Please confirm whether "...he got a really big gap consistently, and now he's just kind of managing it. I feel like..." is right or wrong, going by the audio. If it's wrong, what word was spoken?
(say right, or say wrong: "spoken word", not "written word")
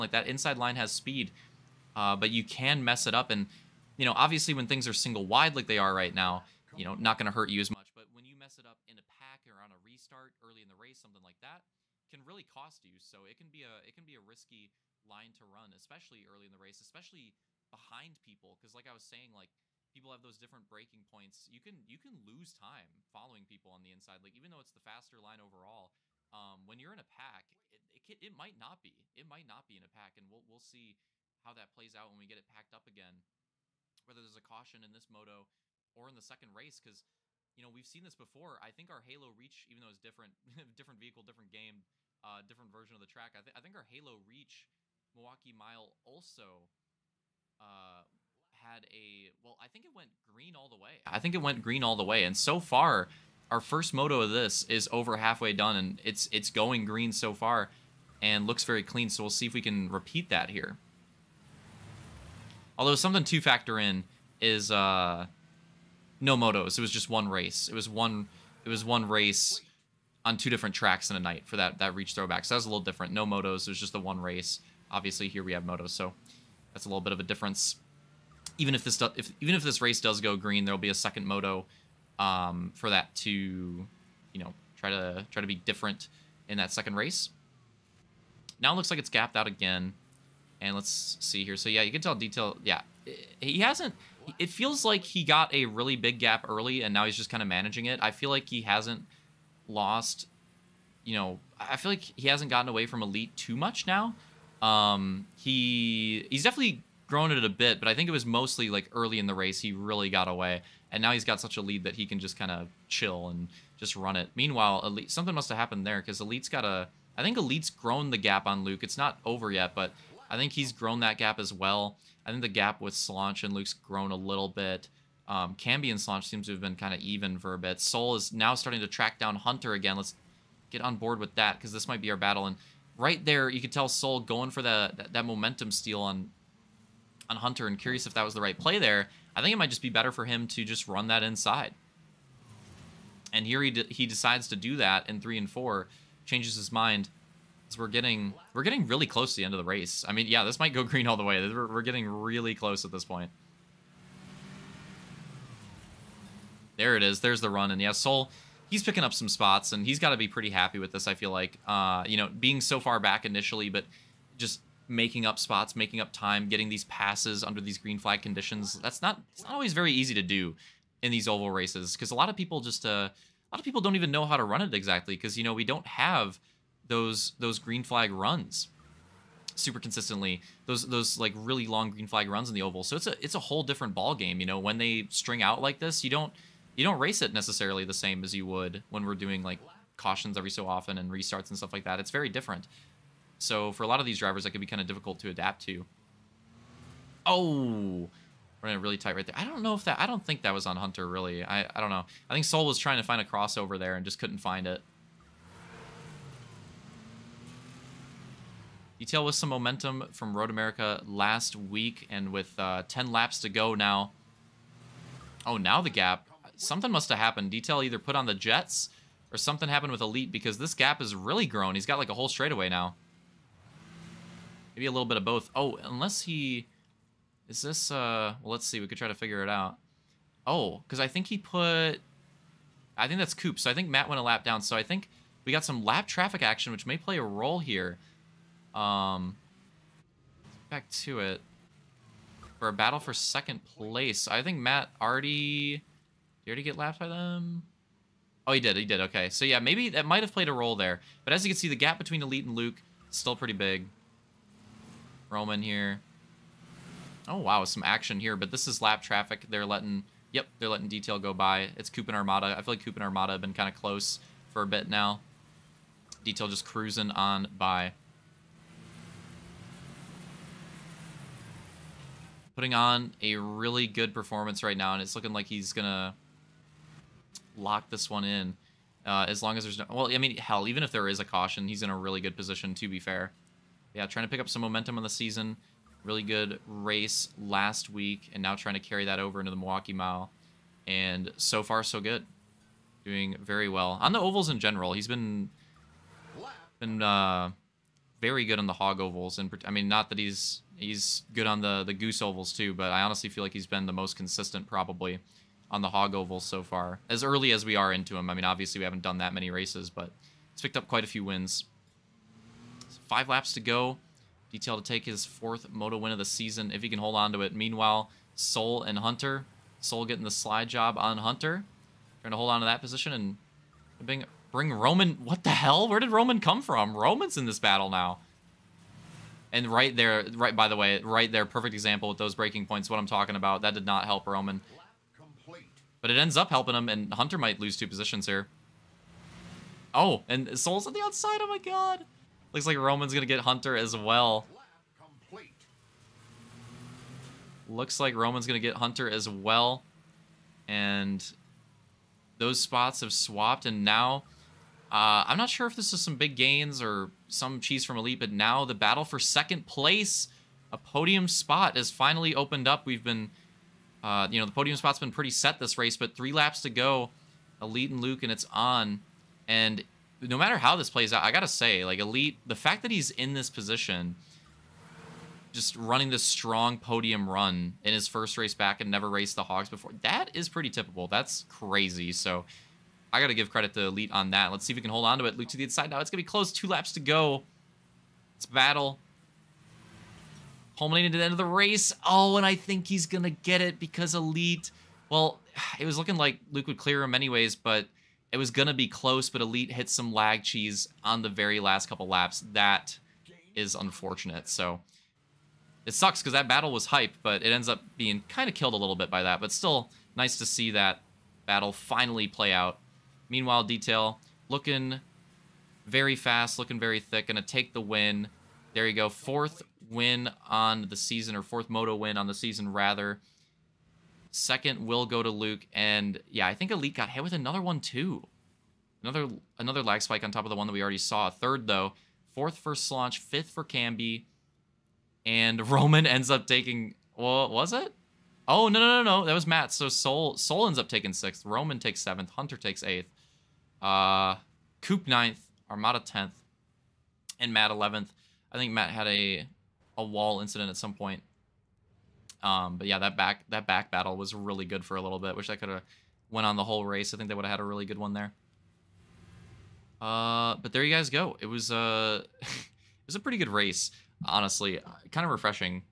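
wrong: "early", not "consistently".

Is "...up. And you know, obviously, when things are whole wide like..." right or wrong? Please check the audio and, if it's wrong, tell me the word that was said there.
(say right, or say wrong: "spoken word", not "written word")
wrong: "single", not "whole".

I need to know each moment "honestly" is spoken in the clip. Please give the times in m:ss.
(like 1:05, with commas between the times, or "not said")
5:03, 7:44.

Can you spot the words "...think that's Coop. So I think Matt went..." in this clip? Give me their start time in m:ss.
3:53.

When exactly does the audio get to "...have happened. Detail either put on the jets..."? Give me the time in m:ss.
3:37.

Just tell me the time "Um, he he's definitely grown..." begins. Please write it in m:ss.
1:44.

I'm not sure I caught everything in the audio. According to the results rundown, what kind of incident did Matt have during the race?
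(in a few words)
A wall incident.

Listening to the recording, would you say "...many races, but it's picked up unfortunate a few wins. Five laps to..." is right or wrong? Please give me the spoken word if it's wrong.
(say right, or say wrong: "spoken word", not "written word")
wrong: "quite", not "unfortunate".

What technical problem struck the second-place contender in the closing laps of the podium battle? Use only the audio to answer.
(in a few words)
Lag cheese.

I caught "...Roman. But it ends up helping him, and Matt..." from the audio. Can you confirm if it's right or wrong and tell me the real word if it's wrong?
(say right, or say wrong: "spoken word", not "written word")
wrong: "Hunter", not "Matt".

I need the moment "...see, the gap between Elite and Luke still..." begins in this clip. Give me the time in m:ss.
4:11.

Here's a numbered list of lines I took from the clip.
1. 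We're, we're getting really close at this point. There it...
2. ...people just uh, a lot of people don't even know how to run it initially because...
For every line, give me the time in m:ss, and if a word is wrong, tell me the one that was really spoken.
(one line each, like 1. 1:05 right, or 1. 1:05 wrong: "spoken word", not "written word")
1. 2:31 right
2. 2:52 wrong: "exactly", not "initially".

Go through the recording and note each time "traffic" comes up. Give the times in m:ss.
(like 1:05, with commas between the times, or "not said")
3:56, 4:19.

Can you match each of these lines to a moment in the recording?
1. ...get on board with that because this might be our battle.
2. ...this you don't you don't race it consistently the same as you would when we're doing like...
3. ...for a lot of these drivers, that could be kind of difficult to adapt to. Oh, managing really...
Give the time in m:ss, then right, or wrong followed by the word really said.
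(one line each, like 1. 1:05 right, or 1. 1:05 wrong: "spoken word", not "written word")
1. 2:10 right
2. 3:05 wrong: "necessarily", not "consistently"
3. 3:13 wrong: "running", not "managing".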